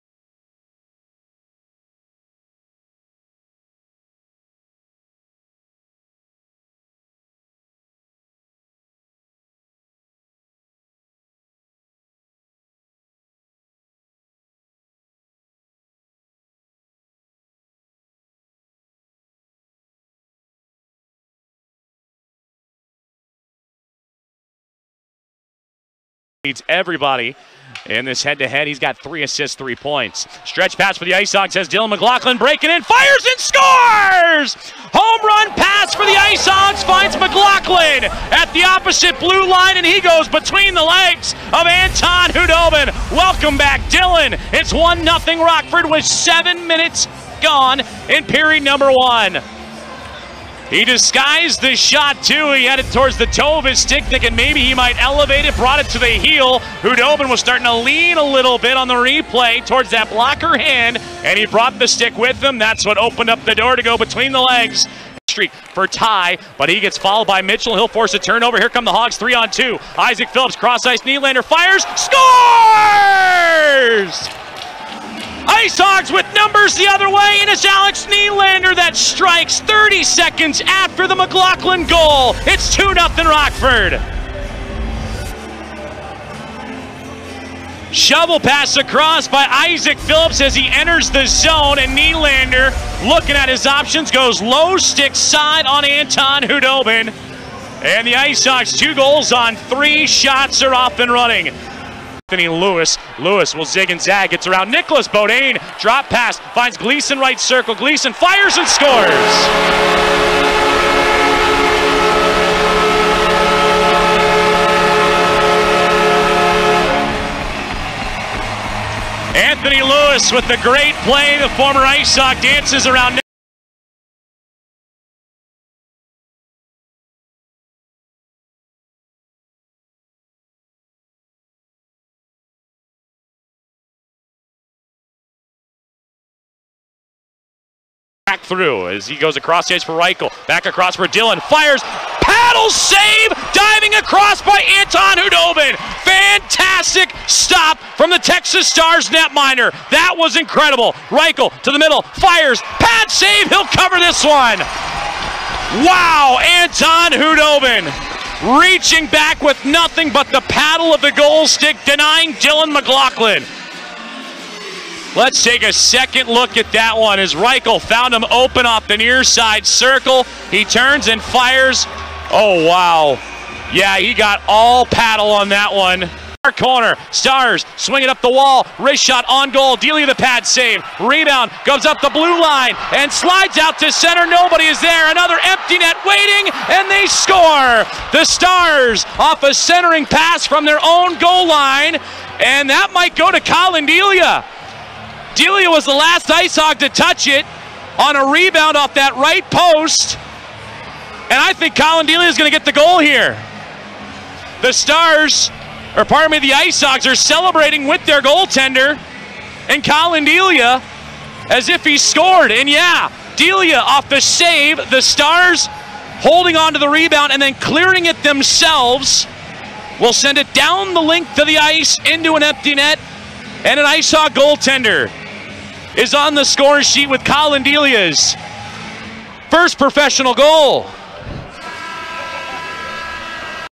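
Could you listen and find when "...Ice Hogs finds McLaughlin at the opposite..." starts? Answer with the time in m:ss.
0:36.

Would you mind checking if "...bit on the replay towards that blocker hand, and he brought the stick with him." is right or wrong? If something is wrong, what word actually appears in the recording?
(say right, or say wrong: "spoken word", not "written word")
right.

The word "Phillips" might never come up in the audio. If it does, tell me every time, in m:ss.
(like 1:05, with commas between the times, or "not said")
1:10, 1:29.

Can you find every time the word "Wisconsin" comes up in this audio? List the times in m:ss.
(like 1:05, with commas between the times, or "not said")
not said.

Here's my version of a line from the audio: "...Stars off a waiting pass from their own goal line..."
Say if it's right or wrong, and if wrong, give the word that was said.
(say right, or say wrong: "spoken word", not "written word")
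wrong: "centering", not "waiting".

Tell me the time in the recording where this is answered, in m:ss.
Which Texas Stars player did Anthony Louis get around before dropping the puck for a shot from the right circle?
1:44.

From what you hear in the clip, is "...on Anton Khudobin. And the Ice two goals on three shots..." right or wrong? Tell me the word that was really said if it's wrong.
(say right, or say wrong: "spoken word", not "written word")
right.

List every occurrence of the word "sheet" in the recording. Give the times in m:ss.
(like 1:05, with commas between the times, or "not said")
3:46.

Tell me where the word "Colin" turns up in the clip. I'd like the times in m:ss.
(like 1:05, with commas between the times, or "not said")
3:13, 3:21, 3:29, 3:47.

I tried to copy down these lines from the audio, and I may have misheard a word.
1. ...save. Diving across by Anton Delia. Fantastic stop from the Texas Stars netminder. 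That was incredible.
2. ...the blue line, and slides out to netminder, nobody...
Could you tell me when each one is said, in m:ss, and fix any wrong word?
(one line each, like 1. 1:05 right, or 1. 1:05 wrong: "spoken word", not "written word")
1. 2:22 wrong: "Khudobin", not "Delia"
2. 3:02 wrong: "center", not "netminder".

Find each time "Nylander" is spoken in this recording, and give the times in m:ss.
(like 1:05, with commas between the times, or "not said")
1:11, 1:18, 1:31.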